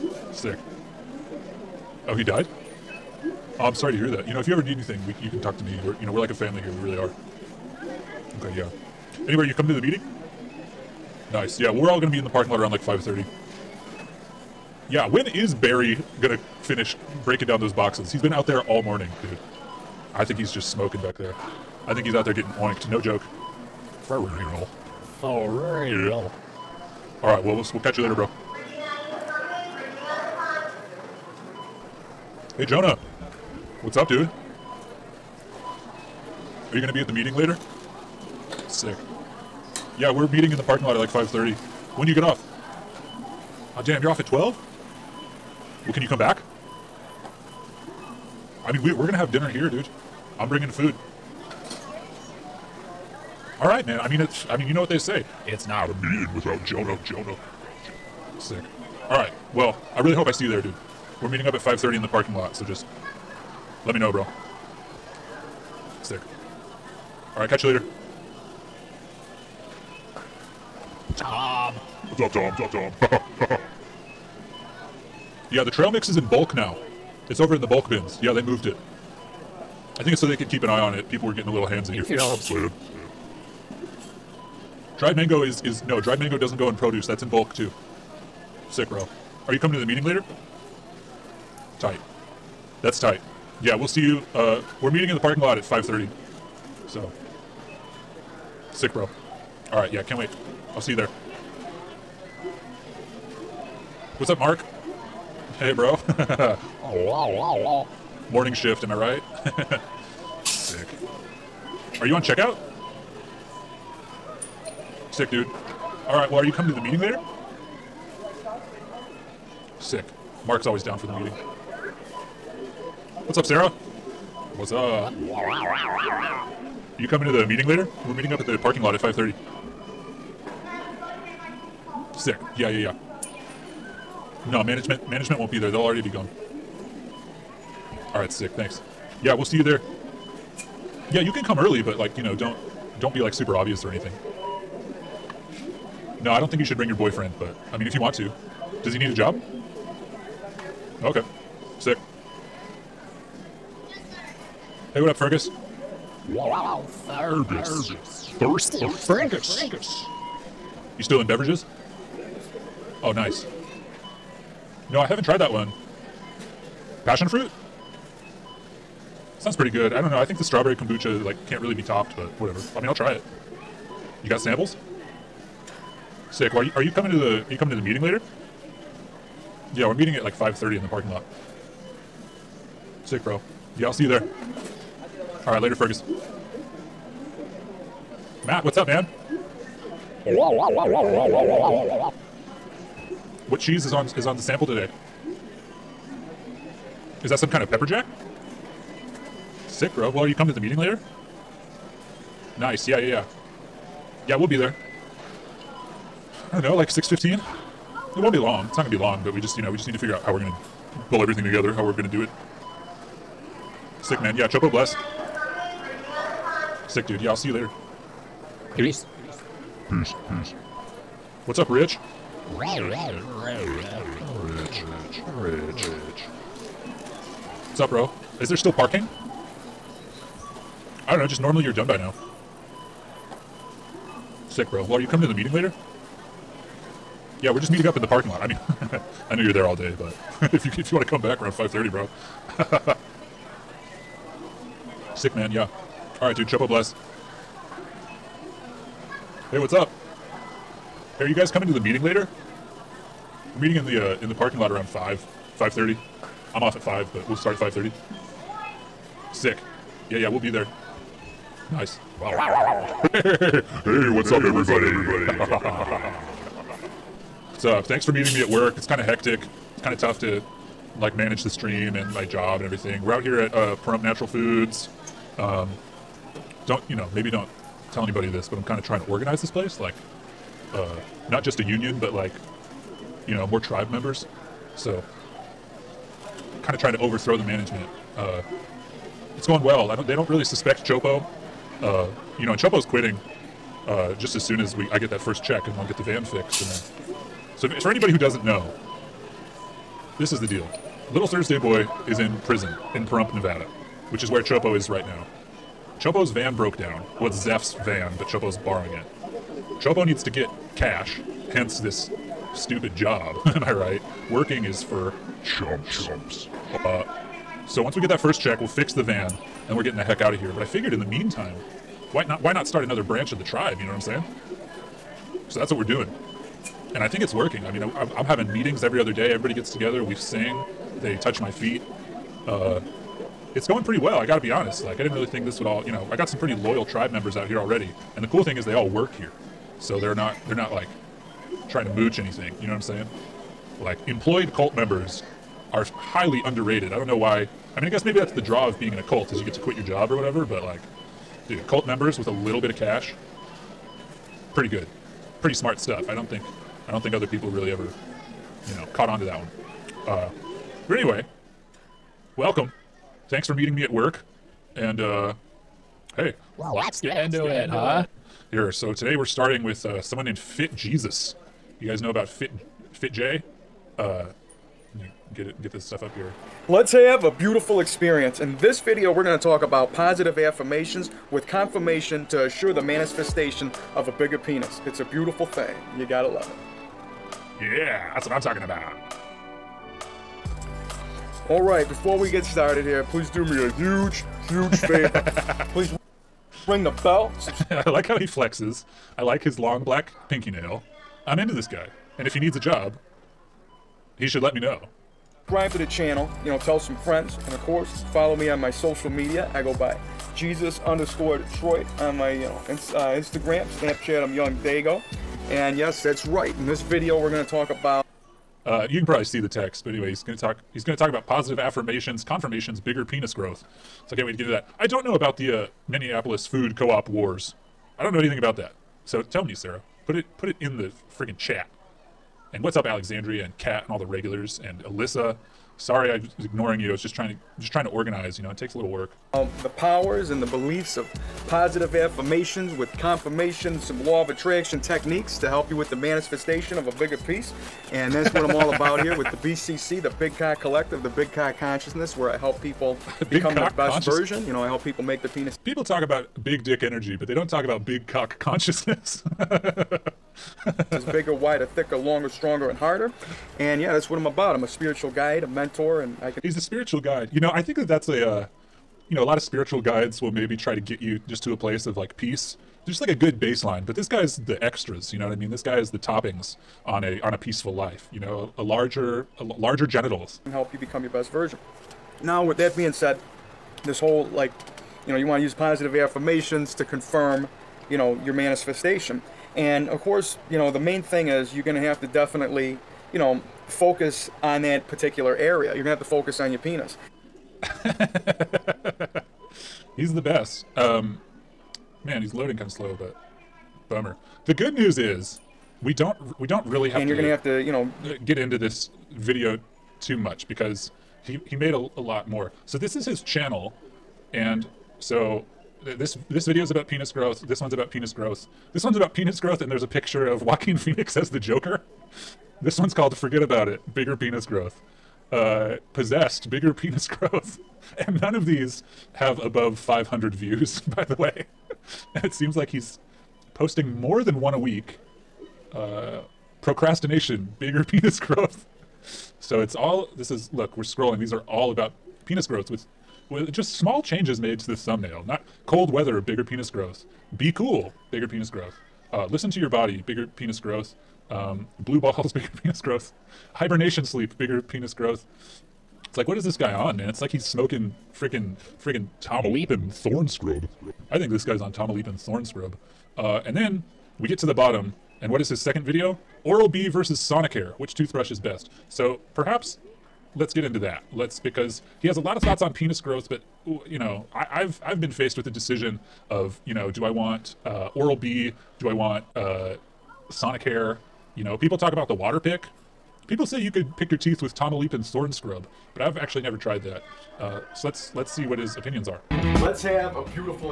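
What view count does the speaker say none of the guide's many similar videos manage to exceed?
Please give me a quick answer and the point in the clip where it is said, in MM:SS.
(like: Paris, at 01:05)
500, at 08:49.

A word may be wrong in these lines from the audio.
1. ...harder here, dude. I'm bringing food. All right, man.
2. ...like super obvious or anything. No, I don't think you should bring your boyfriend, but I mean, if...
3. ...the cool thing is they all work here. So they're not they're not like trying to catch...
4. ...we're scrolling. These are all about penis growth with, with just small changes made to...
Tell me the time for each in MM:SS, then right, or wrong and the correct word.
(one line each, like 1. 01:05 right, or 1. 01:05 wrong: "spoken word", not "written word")
1. 00:49 wrong: "dinner", not "harder"
2. 02:23 right
3. 05:38 wrong: "mooch", not "catch"
4. 09:00 right.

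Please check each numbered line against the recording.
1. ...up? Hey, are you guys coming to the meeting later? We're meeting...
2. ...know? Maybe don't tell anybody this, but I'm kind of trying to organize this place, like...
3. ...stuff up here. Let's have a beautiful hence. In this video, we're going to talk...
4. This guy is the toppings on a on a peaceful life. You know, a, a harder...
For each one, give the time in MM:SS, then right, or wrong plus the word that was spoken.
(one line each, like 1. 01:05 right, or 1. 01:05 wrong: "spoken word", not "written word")
1. 04:09 right
2. 04:36 right
3. 06:15 wrong: "experience", not "hence"
4. 07:55 wrong: "larger", not "harder".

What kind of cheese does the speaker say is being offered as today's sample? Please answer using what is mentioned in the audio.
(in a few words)
Pepper jack.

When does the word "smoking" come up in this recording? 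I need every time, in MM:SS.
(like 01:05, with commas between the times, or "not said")
00:20, 09:17.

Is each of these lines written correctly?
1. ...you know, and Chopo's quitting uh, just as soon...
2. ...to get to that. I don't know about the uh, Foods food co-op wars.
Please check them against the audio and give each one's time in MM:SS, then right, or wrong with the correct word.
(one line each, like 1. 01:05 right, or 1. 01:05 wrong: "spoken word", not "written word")
1. 04:52 right
2. 07:04 wrong: "Minneapolis", not "Foods".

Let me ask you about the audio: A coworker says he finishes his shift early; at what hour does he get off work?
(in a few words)
12.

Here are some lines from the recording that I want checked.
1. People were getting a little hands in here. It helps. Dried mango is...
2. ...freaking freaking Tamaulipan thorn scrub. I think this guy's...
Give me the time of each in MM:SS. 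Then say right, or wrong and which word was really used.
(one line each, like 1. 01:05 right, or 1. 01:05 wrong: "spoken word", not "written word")
1. 01:21 right
2. 09:18 right.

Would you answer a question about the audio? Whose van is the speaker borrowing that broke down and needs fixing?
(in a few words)
Zeph.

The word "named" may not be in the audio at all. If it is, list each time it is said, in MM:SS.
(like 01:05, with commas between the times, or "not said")
06:10.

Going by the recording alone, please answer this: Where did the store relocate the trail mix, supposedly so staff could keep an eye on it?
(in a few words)
The bulk bins.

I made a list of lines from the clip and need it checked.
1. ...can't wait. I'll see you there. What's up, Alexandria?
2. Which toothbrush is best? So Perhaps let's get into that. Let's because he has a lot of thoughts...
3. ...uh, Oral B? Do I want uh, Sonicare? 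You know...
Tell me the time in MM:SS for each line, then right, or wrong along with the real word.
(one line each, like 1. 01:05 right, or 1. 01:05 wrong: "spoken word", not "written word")
1. 01:40 wrong: "Mark", not "Alexandria"
2. 09:27 right
3. 09:37 right.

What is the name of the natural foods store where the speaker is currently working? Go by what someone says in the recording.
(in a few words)
Pahrump Natural Foods.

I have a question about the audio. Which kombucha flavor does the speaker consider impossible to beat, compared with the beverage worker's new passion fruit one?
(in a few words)
Strawberry.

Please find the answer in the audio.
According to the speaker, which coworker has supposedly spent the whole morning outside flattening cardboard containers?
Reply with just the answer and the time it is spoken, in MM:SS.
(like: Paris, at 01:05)
Barry, at 00:15.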